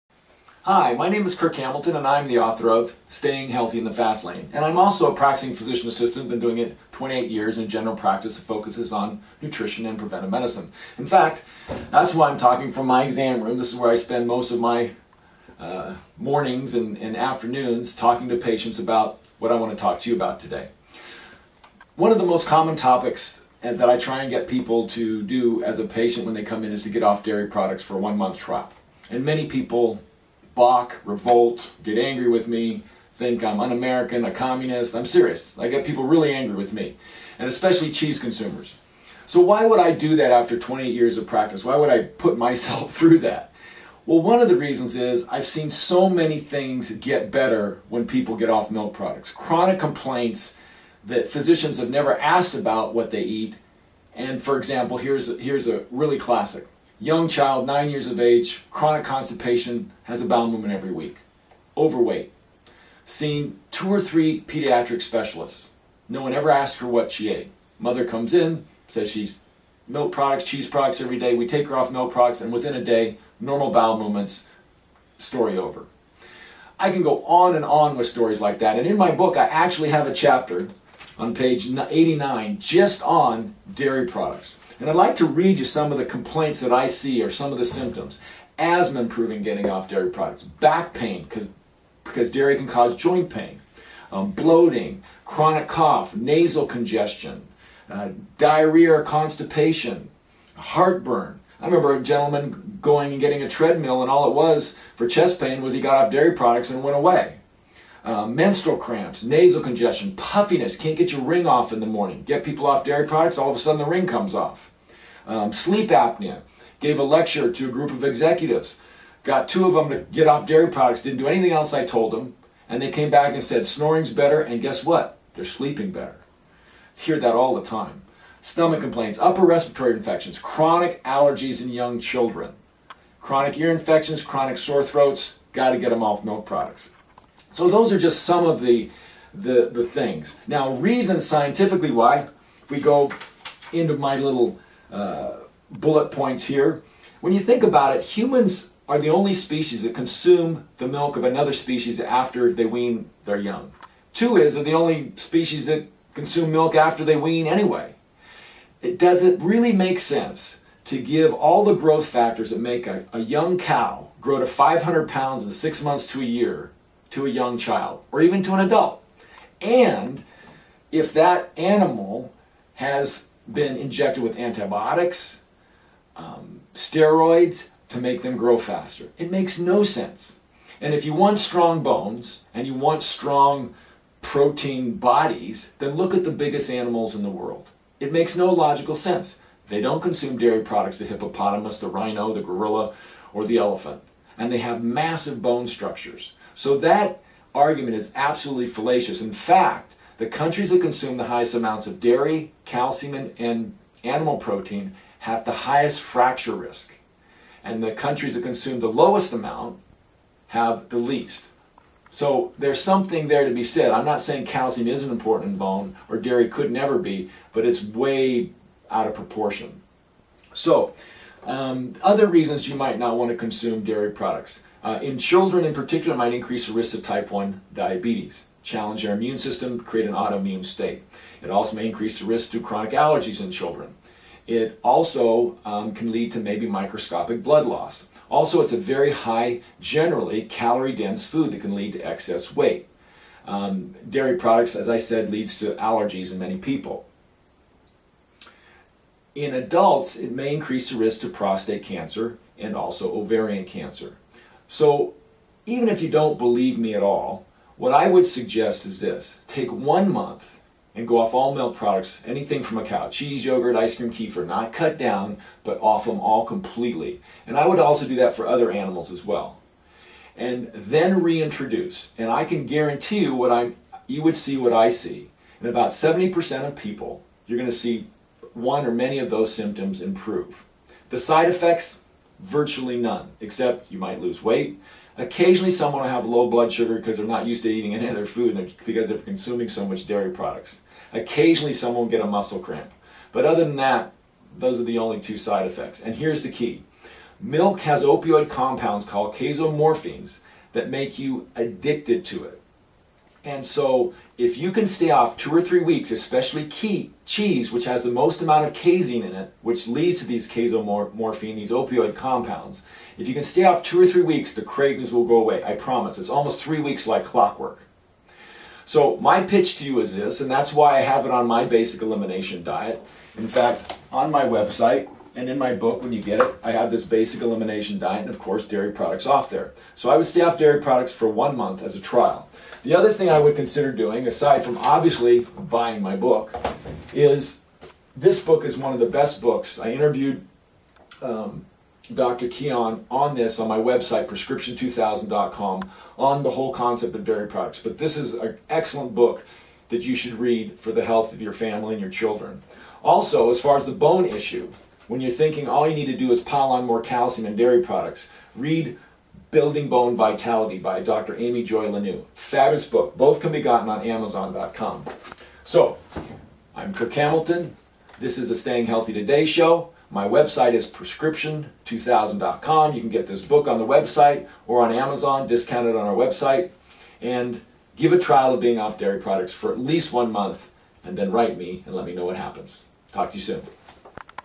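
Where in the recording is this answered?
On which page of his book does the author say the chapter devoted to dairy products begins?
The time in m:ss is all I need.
1:21.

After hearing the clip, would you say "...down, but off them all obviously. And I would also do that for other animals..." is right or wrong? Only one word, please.
wrong.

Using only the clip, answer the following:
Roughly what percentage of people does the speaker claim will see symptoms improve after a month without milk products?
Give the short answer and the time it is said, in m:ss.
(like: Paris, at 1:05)
70%, at 4:35.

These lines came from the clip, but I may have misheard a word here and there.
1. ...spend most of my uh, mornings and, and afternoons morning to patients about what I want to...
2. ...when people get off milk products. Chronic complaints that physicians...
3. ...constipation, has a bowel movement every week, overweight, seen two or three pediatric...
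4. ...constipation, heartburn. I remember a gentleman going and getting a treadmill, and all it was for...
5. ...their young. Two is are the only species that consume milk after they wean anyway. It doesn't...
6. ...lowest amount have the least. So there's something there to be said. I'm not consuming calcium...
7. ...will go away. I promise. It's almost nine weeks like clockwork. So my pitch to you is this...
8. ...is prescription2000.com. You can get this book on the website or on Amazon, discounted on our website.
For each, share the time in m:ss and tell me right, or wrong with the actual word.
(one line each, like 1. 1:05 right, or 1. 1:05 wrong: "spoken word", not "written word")
1. 0:13 wrong: "talking", not "morning"
2. 0:47 right
3. 0:59 right
4. 1:39 right
5. 2:33 right
6. 3:28 wrong: "saying", not "consuming"
7. 5:15 wrong: "three", not "nine"
8. 6:10 right.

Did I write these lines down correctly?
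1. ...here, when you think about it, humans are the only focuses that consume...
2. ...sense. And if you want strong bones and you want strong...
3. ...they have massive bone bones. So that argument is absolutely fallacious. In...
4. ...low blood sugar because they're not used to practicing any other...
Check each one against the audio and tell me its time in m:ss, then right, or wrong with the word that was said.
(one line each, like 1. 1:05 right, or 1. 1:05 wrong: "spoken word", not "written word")
1. 2:26 wrong: "species", not "focuses"
2. 2:59 right
3. 3:14 wrong: "structures", not "bones"
4. 4:46 wrong: "eating", not "practicing".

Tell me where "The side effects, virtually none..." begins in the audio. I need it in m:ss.
4:41.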